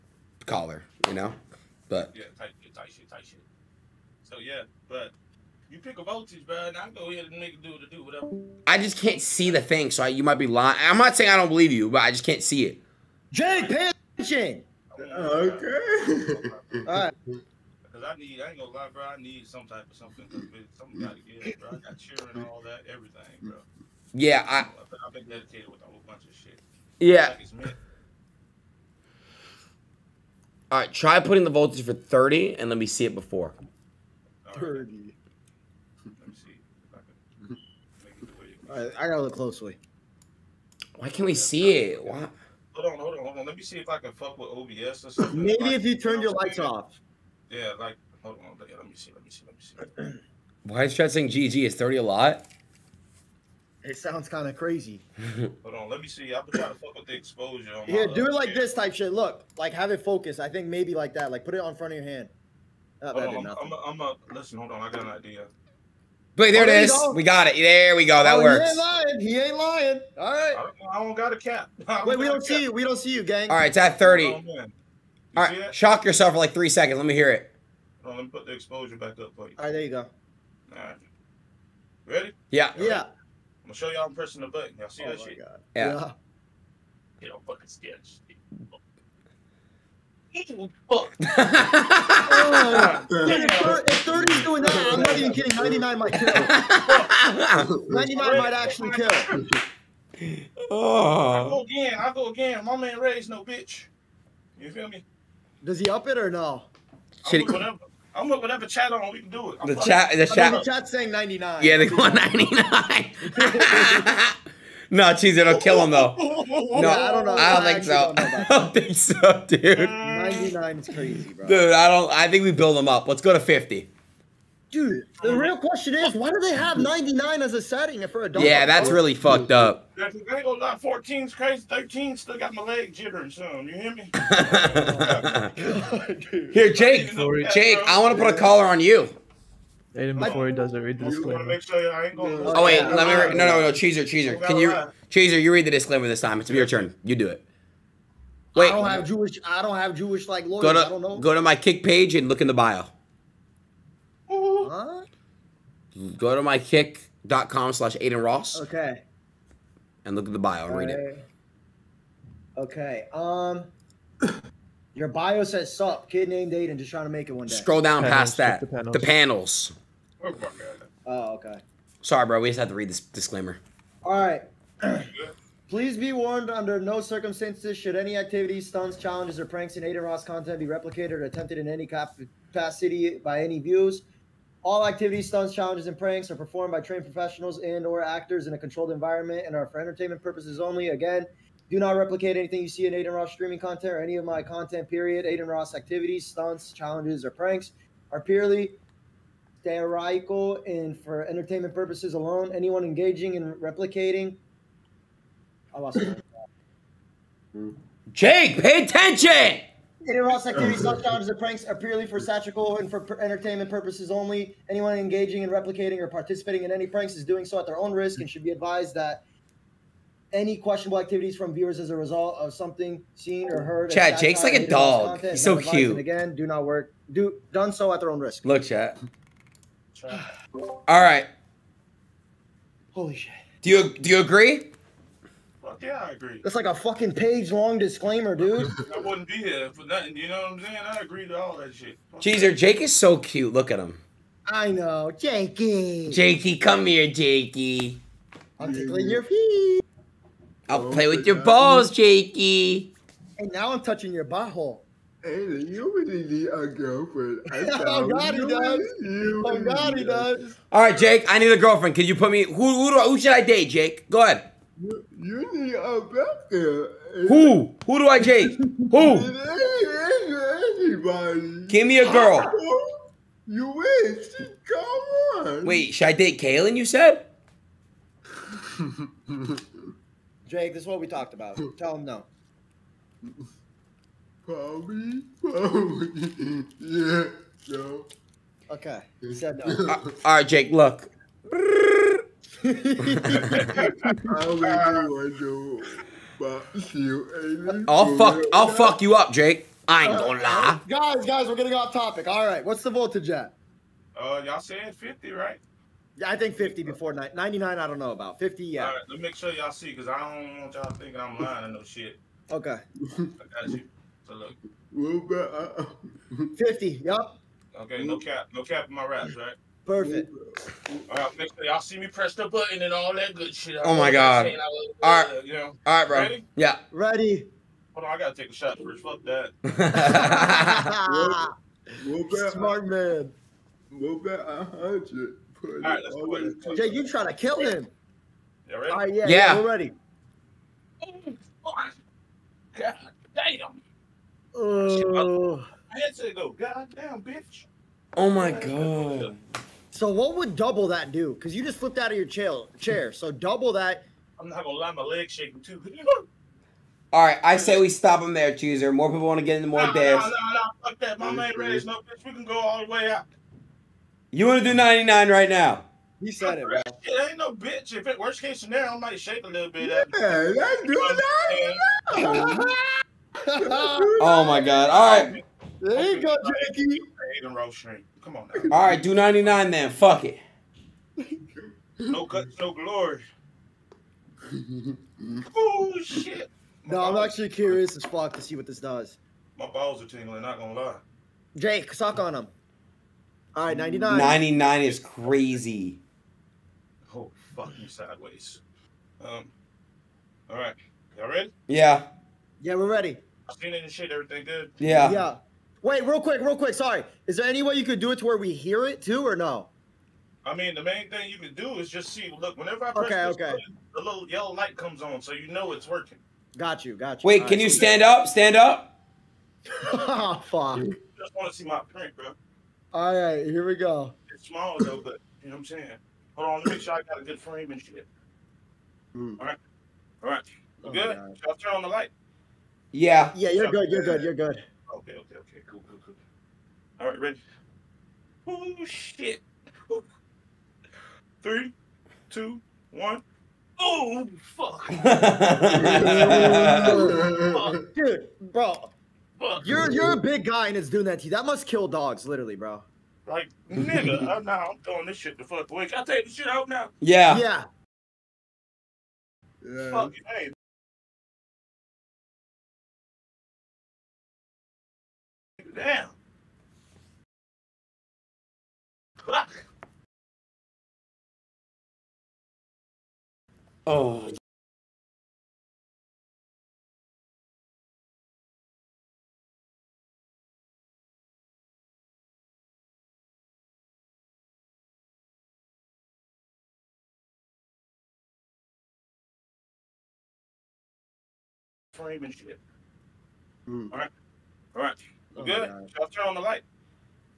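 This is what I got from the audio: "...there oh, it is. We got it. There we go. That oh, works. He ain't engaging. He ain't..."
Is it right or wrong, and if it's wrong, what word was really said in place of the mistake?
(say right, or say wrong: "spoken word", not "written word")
wrong: "lying", not "engaging".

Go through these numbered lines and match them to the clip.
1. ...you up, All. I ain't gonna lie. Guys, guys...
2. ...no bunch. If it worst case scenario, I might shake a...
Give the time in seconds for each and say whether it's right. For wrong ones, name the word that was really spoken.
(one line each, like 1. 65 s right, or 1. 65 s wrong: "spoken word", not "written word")
1. 299 s wrong: "Jake", not "All"
2. 367 s wrong: "bitch", not "bunch".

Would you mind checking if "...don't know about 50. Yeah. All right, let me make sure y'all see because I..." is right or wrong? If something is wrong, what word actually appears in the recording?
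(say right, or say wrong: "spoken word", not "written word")
right.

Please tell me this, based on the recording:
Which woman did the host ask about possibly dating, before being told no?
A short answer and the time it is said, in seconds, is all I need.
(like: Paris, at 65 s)
Kaylin, at 276 s.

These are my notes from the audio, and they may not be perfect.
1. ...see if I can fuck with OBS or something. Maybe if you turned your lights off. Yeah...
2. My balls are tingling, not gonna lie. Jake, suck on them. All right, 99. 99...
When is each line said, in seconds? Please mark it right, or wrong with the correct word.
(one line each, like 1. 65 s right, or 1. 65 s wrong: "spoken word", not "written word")
1. 43 s right
2. 389 s right.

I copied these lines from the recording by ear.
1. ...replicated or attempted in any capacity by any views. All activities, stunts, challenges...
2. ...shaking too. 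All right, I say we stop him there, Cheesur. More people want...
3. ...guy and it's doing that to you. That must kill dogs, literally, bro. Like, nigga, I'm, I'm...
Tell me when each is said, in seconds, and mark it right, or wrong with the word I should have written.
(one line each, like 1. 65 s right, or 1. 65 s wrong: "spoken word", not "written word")
1. 180 s right
2. 355 s right
3. 450 s right.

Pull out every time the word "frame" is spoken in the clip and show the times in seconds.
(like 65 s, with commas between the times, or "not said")
427 s, 491 s.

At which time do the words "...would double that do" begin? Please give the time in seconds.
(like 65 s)
350 s.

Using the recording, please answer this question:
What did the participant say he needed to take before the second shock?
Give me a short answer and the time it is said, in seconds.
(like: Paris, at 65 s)
a shot, at 328 s.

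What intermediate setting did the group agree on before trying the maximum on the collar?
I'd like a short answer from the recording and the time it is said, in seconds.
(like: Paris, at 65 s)
50, at 123 s.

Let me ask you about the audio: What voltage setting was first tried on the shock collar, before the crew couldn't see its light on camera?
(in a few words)
30.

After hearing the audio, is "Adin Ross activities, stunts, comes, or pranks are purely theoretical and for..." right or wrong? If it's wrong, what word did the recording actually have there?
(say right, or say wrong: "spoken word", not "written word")
wrong: "challenges", not "comes".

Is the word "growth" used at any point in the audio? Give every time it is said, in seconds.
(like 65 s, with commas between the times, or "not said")
not said.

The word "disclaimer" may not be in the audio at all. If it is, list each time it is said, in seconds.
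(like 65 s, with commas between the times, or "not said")
141 s, 145 s, 172 s, 237 s.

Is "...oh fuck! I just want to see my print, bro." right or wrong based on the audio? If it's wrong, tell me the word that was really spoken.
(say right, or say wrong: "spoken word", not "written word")
right.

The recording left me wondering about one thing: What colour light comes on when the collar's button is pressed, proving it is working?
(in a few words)
yellow.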